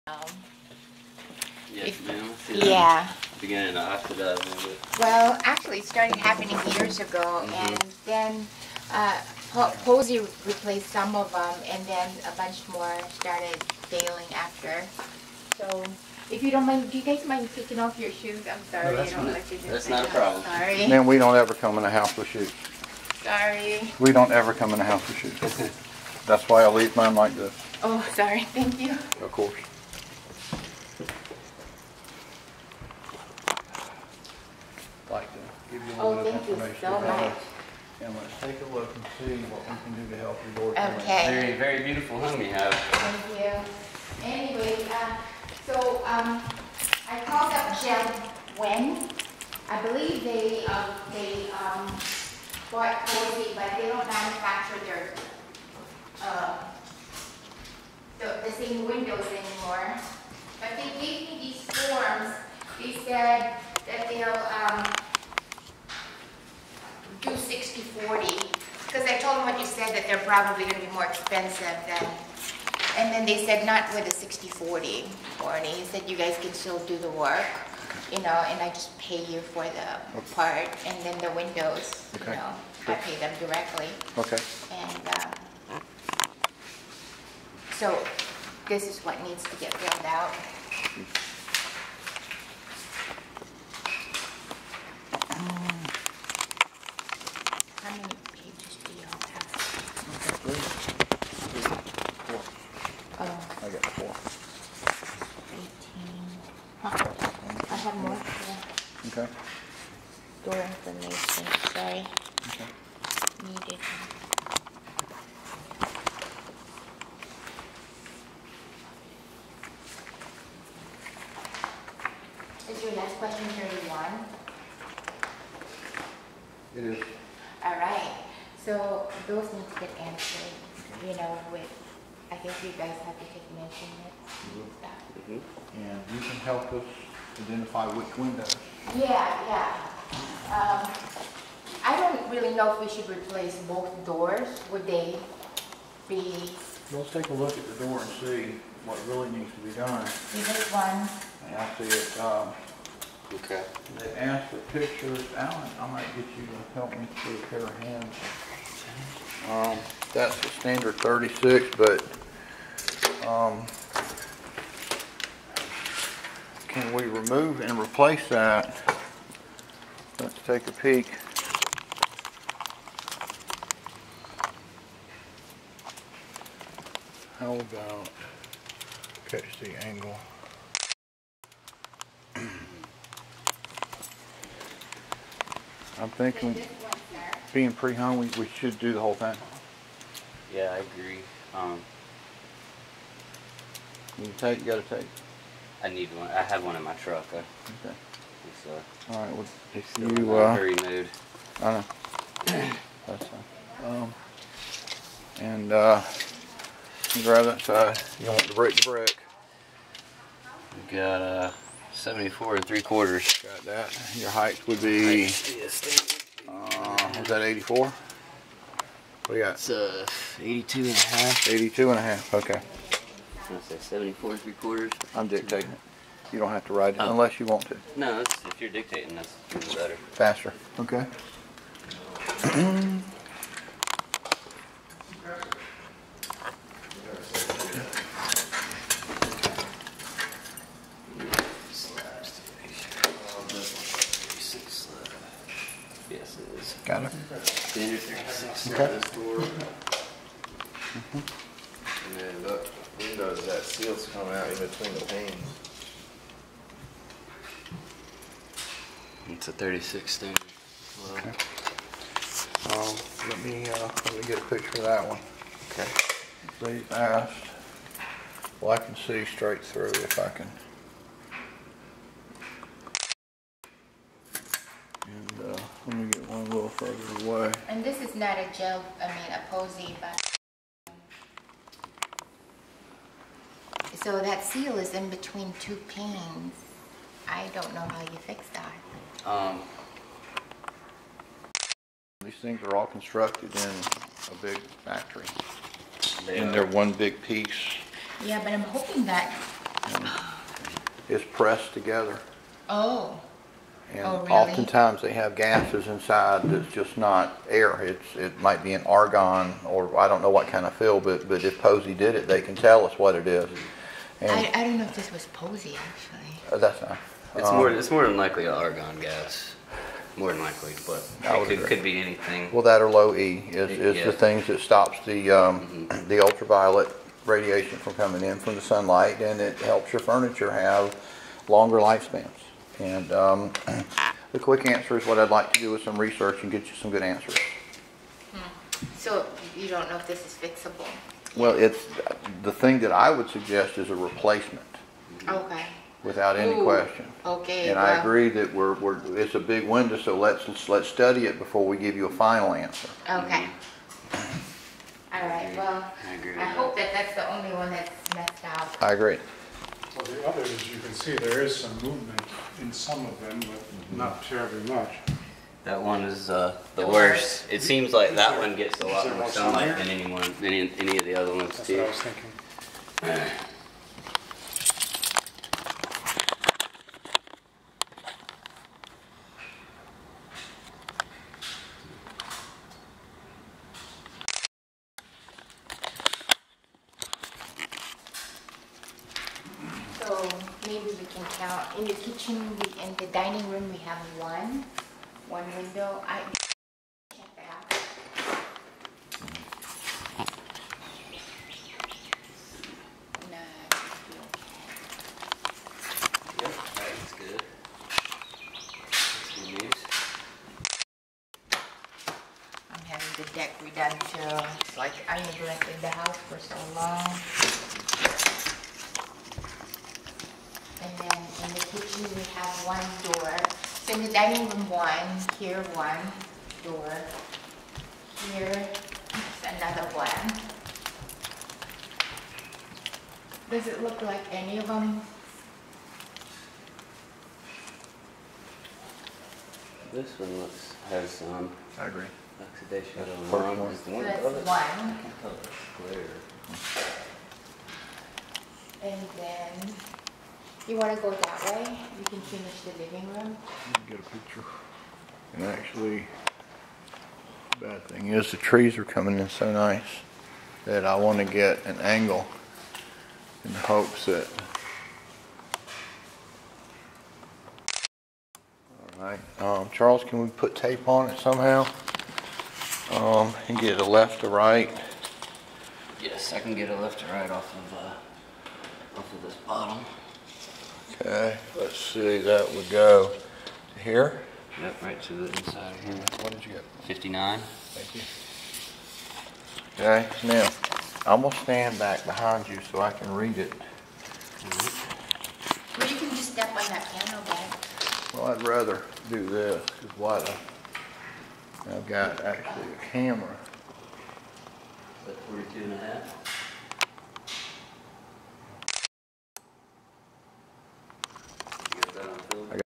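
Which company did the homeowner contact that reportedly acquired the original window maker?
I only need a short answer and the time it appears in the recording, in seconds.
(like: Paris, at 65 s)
Jeld-Wen, at 47 s.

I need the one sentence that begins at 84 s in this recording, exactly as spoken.
Okay, And, um, so this is what needs to get filled out.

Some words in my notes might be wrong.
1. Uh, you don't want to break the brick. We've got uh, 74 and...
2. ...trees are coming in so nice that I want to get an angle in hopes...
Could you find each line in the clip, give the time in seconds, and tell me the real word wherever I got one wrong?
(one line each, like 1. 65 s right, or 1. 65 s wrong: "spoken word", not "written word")
1. 207 s right
2. 458 s right.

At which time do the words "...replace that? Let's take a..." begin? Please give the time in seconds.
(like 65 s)
167 s.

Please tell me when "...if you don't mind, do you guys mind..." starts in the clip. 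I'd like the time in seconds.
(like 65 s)
16 s.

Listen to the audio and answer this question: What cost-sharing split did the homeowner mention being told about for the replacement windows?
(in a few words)
60-40.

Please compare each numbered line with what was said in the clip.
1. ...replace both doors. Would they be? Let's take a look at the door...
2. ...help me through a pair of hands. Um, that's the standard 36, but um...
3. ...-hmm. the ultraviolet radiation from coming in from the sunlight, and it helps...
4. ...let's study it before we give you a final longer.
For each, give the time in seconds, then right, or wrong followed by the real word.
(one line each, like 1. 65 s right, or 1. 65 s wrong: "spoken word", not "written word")
1. 143 s right
2. 156 s right
3. 325 s right
4. 350 s wrong: "answer", not "longer".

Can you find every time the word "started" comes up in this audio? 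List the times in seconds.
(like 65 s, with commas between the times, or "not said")
5 s, 13 s.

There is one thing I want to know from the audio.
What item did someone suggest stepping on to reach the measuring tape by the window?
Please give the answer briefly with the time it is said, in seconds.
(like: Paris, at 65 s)
piano bag, at 496 s.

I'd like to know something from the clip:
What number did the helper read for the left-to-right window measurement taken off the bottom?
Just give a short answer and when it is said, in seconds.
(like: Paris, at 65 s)
59, at 486 s.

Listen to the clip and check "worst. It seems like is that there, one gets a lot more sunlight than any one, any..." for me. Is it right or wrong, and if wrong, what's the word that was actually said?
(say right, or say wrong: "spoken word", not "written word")
right.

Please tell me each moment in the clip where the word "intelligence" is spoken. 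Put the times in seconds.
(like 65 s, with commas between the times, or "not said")
not said.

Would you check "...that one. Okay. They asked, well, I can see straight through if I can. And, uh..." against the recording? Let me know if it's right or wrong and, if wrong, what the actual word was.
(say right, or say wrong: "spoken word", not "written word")
right.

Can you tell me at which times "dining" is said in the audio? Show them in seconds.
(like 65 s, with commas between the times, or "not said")
393 s, 424 s.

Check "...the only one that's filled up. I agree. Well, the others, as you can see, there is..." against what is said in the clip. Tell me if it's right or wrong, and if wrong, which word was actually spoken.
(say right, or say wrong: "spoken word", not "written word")
wrong: "messed", not "filled".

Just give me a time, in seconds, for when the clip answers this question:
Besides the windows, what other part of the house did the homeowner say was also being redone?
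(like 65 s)
413 s.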